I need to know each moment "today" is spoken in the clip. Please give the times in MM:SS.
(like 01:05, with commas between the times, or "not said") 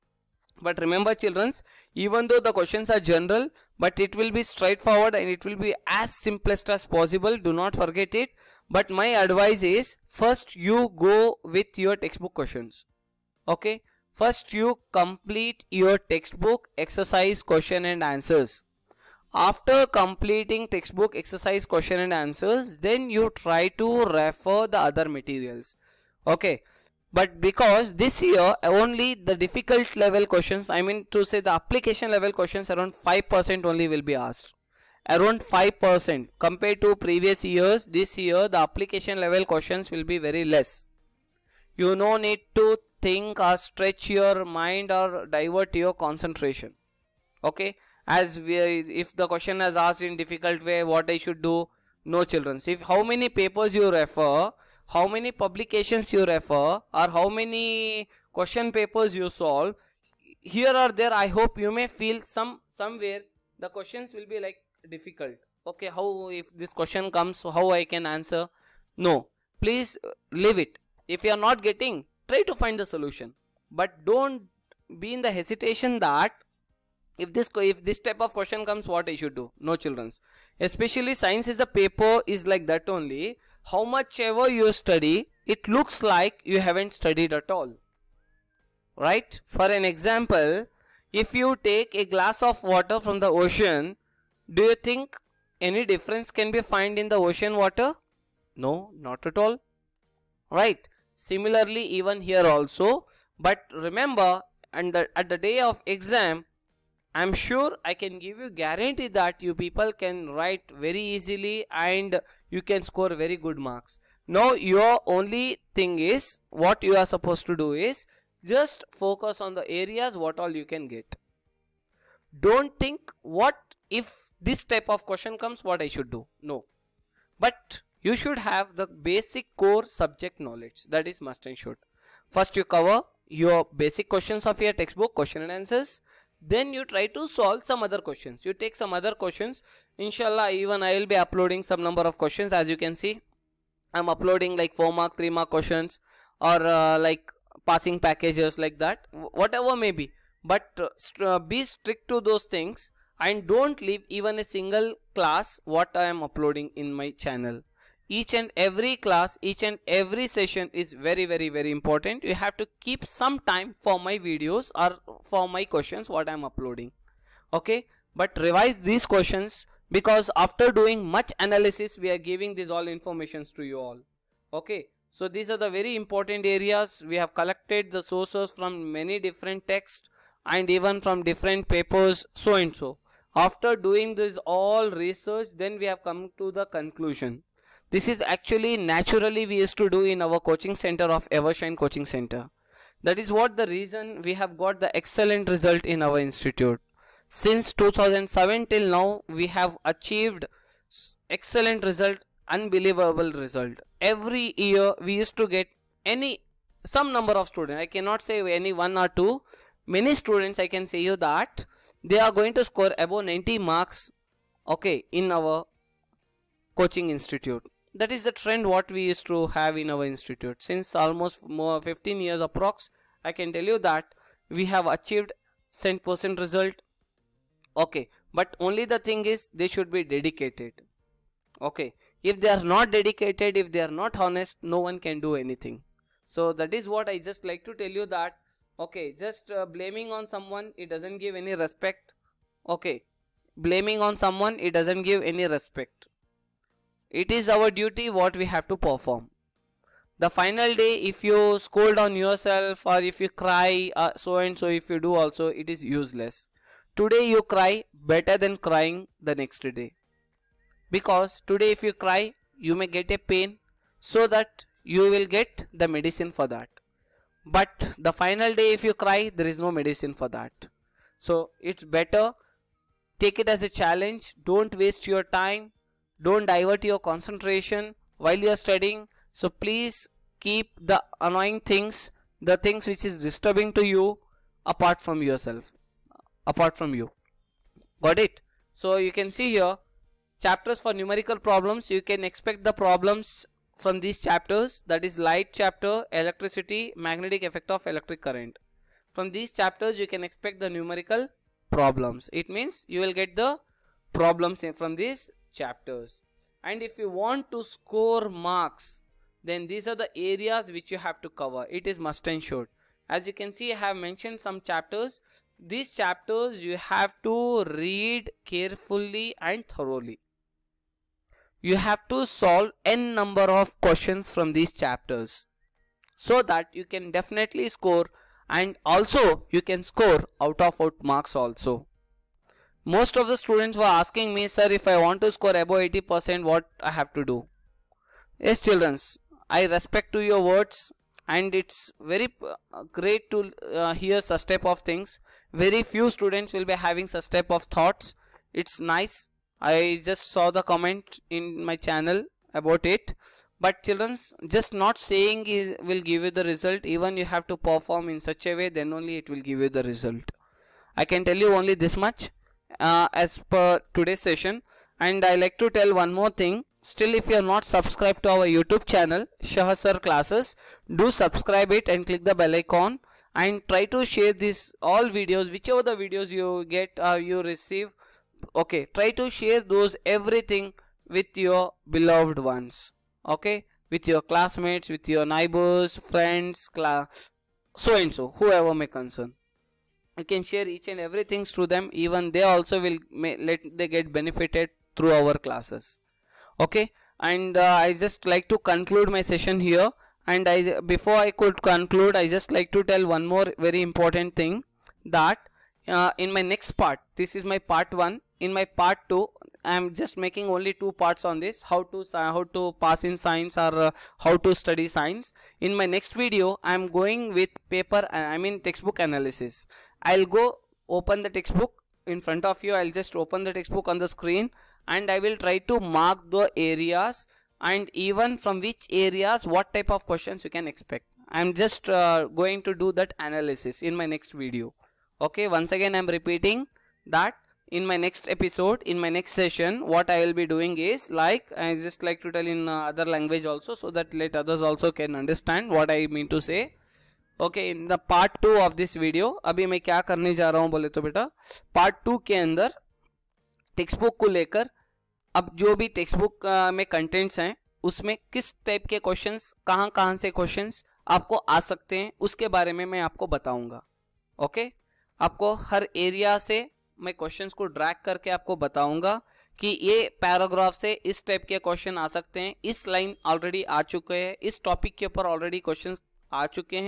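04:16, 04:21, 06:03.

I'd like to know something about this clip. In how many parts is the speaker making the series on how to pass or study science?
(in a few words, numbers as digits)
2.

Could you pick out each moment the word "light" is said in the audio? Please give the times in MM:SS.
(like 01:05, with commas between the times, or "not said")
04:55.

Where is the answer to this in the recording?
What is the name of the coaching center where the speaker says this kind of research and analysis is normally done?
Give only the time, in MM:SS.
03:11.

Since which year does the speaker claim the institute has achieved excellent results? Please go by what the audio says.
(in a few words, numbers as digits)
2007.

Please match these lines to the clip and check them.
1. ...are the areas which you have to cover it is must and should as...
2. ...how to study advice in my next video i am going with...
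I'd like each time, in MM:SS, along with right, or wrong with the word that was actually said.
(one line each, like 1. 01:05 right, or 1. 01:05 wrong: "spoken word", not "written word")
1. 05:09 right
2. 06:54 wrong: "science", not "advice".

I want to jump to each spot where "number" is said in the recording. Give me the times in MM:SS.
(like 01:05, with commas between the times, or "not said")
02:21, 03:27, 05:23.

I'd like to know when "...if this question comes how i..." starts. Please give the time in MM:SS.
01:06.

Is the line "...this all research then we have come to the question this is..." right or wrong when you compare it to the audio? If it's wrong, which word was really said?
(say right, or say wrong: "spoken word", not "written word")
wrong: "conclusion", not "question".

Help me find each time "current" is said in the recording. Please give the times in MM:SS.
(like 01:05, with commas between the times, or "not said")
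04:58.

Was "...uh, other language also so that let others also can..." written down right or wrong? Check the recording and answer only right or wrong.
right.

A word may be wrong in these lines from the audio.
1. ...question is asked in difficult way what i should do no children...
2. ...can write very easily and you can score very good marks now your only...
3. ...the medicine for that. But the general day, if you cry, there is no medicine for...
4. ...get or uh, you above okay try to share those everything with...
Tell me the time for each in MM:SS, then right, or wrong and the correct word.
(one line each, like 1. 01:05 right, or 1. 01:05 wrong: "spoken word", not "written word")
1. 00:49 right
2. 01:50 right
3. 04:25 wrong: "final", not "general"
4. 06:16 wrong: "receive", not "above".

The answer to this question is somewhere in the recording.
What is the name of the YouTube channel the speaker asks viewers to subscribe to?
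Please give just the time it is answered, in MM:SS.
06:09.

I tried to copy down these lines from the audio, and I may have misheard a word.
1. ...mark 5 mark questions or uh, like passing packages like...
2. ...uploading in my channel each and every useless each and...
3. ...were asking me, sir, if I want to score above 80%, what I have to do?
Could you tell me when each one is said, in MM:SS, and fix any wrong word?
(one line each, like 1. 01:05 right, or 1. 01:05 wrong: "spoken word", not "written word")
1. 02:25 wrong: "3", not "5"
2. 02:36 wrong: "class", not "useless"
3. 05:33 right.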